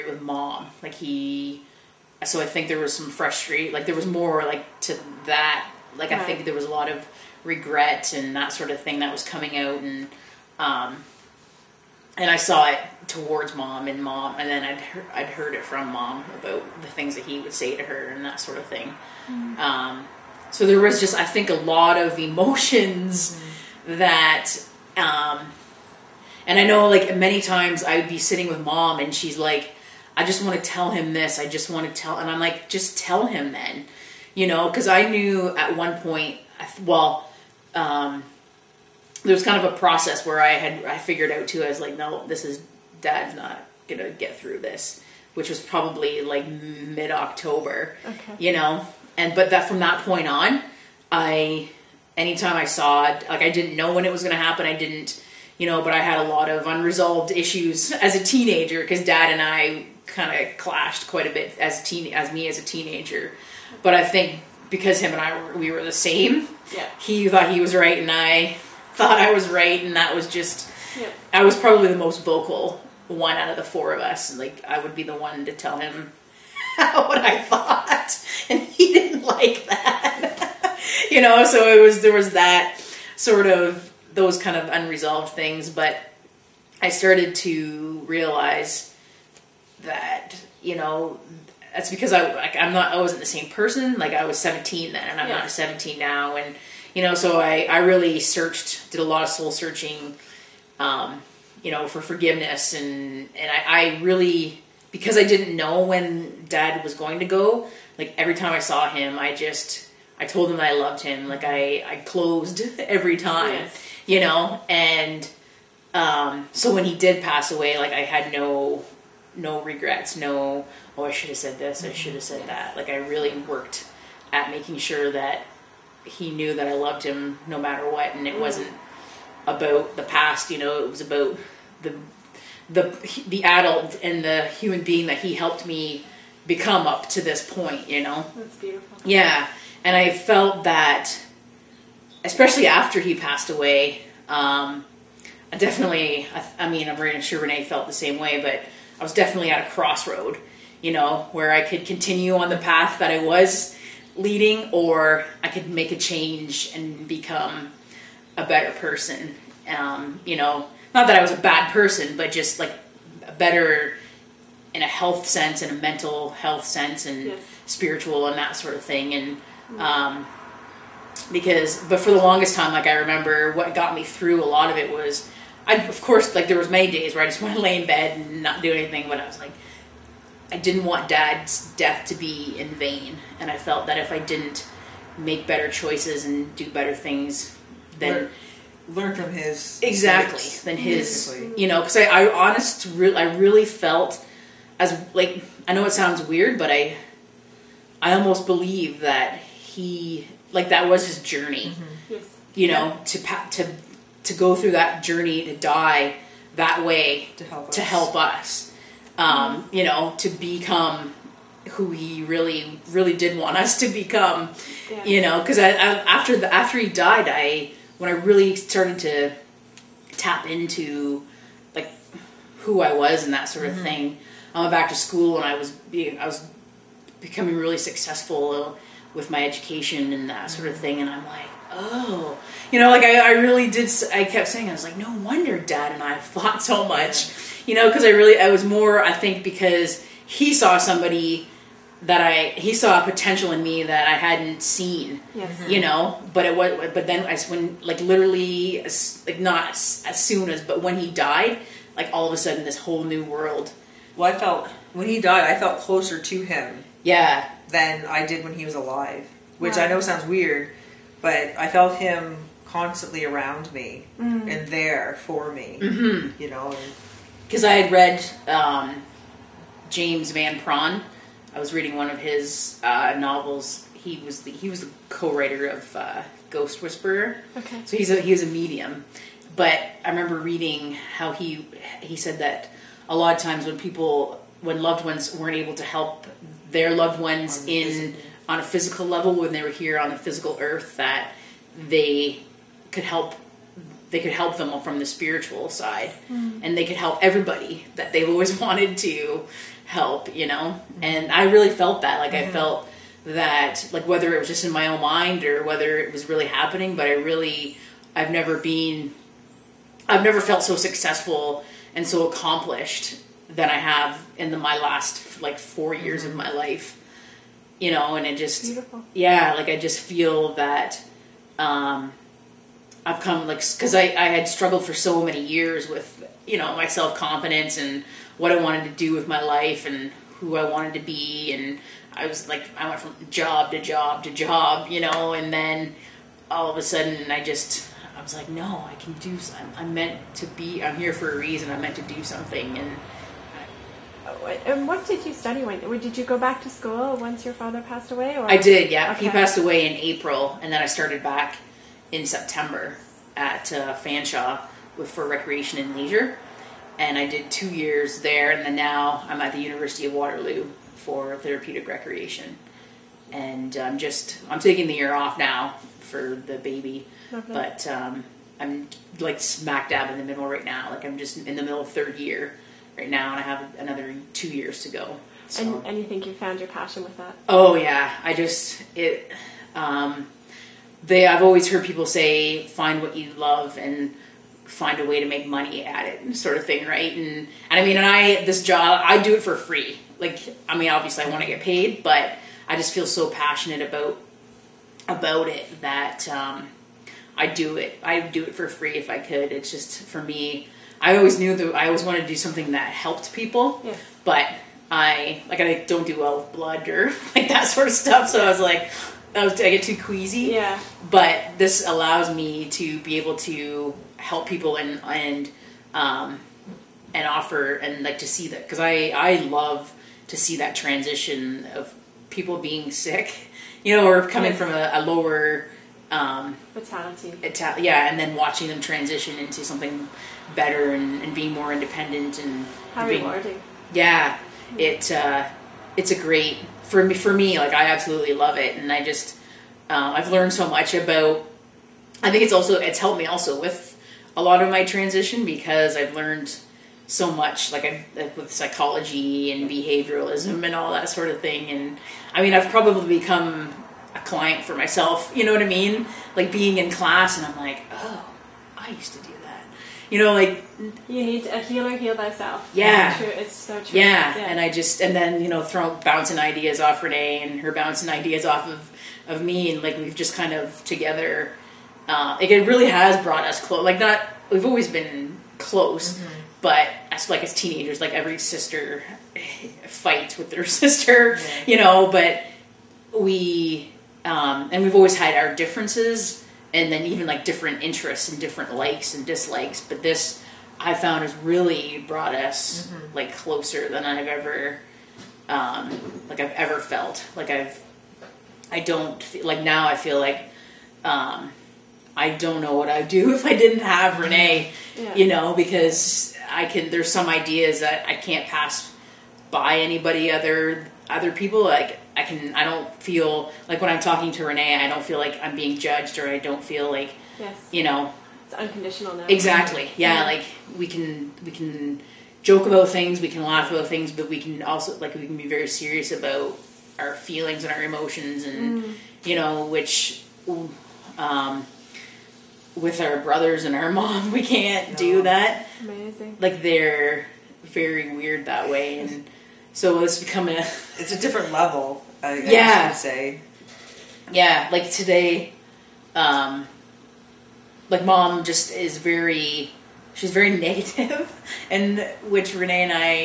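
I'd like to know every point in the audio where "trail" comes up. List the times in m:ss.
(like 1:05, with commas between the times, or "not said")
not said.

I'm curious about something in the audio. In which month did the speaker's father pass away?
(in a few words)
April.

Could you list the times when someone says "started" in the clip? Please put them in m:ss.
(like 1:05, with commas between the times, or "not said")
1:26, 3:38, 5:50.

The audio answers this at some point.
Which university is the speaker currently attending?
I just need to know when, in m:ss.
5:59.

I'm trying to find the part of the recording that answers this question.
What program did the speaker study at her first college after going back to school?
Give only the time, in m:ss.
5:55.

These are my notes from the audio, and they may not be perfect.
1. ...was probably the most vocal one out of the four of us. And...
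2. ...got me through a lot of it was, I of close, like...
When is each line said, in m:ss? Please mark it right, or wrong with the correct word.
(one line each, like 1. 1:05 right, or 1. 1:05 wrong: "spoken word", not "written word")
1. 1:11 right
2. 2:53 wrong: "course", not "close".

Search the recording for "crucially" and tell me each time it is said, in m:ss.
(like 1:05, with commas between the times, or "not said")
not said.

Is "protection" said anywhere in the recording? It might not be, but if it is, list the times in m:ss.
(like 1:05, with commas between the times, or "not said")
not said.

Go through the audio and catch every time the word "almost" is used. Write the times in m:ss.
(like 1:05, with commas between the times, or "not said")
3:18.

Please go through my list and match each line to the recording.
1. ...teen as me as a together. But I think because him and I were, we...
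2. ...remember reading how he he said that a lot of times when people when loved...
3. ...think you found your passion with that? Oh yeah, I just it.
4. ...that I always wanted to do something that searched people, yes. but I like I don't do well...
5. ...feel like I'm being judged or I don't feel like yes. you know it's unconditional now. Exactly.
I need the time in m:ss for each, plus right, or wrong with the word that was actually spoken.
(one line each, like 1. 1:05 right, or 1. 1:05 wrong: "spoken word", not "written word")
1. 1:01 wrong: "teenager", not "together"
2. 4:40 right
3. 6:16 right
4. 6:41 wrong: "helped", not "searched"
5. 8:35 right.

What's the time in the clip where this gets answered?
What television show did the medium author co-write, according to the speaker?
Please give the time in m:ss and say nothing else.
4:36.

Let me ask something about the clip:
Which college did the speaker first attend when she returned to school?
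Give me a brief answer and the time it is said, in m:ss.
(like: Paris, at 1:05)
Fanshawe, at 5:53.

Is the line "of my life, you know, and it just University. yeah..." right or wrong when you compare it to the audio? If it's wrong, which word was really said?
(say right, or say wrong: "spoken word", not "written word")
wrong: "Beautiful", not "University".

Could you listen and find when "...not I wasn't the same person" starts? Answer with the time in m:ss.
1:32.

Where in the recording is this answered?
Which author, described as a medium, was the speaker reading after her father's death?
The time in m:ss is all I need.
4:29.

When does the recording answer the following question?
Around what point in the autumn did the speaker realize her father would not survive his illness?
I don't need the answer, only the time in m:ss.
0:46.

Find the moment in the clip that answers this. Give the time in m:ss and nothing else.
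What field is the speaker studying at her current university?
6:01.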